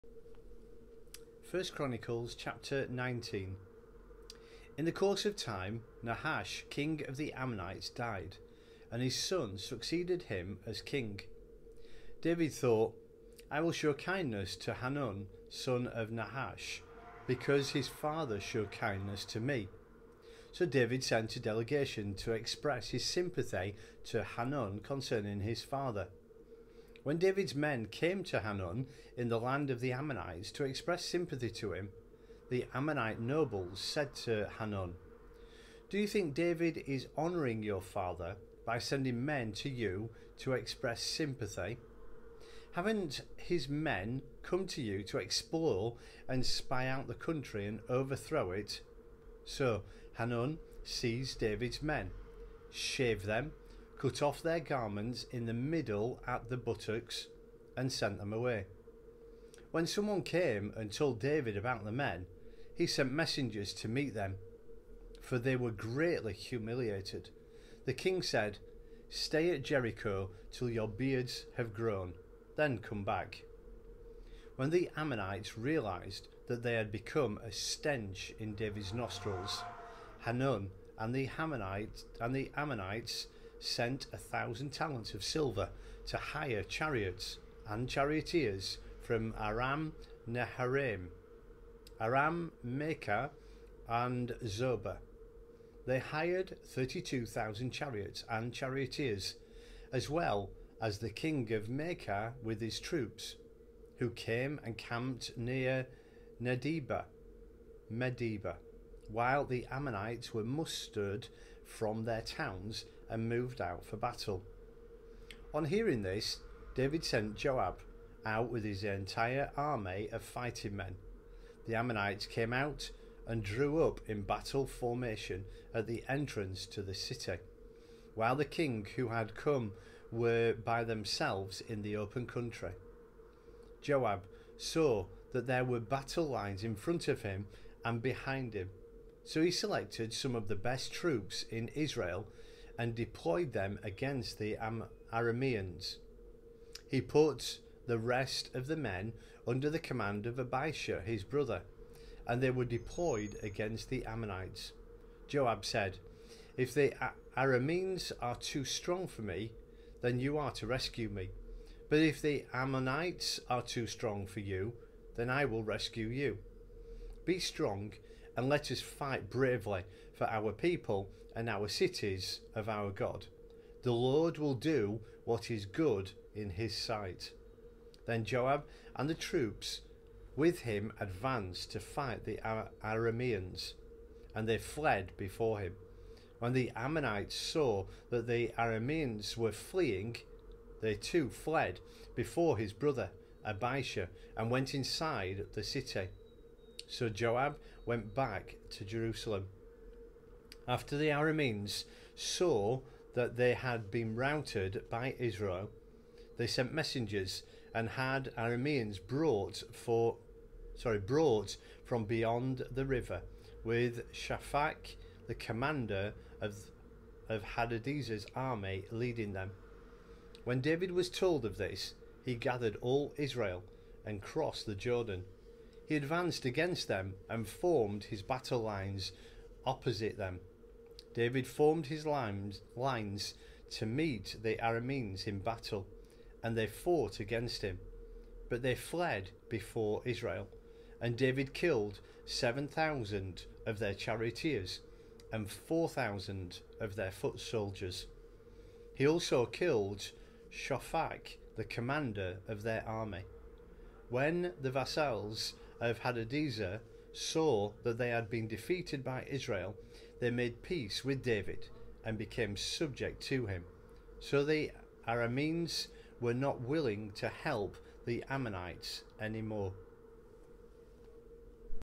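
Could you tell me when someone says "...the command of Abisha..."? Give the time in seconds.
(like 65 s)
149 s.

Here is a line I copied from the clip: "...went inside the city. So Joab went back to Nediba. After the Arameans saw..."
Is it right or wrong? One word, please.
wrong.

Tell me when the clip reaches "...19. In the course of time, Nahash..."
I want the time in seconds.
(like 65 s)
2 s.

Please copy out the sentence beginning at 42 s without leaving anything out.
Haven't his men come to you to explore and spy out the country and overthrow it?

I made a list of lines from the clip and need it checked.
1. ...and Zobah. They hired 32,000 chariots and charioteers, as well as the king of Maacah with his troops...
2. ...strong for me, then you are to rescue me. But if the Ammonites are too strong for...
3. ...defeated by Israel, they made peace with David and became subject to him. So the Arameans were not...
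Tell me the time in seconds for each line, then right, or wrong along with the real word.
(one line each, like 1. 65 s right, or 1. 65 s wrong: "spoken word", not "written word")
1. 93 s right
2. 158 s right
3. 258 s right.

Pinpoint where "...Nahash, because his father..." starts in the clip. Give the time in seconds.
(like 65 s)
16 s.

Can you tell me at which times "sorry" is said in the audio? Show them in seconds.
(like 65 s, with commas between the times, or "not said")
210 s.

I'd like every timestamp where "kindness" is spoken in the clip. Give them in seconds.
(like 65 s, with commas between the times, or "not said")
13 s, 18 s.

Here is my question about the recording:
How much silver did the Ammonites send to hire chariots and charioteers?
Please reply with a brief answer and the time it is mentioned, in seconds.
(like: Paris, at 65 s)
1,000 talents, at 84 s.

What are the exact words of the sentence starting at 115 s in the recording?
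On hearing this, David sent Joab out with his entire army of fighting men.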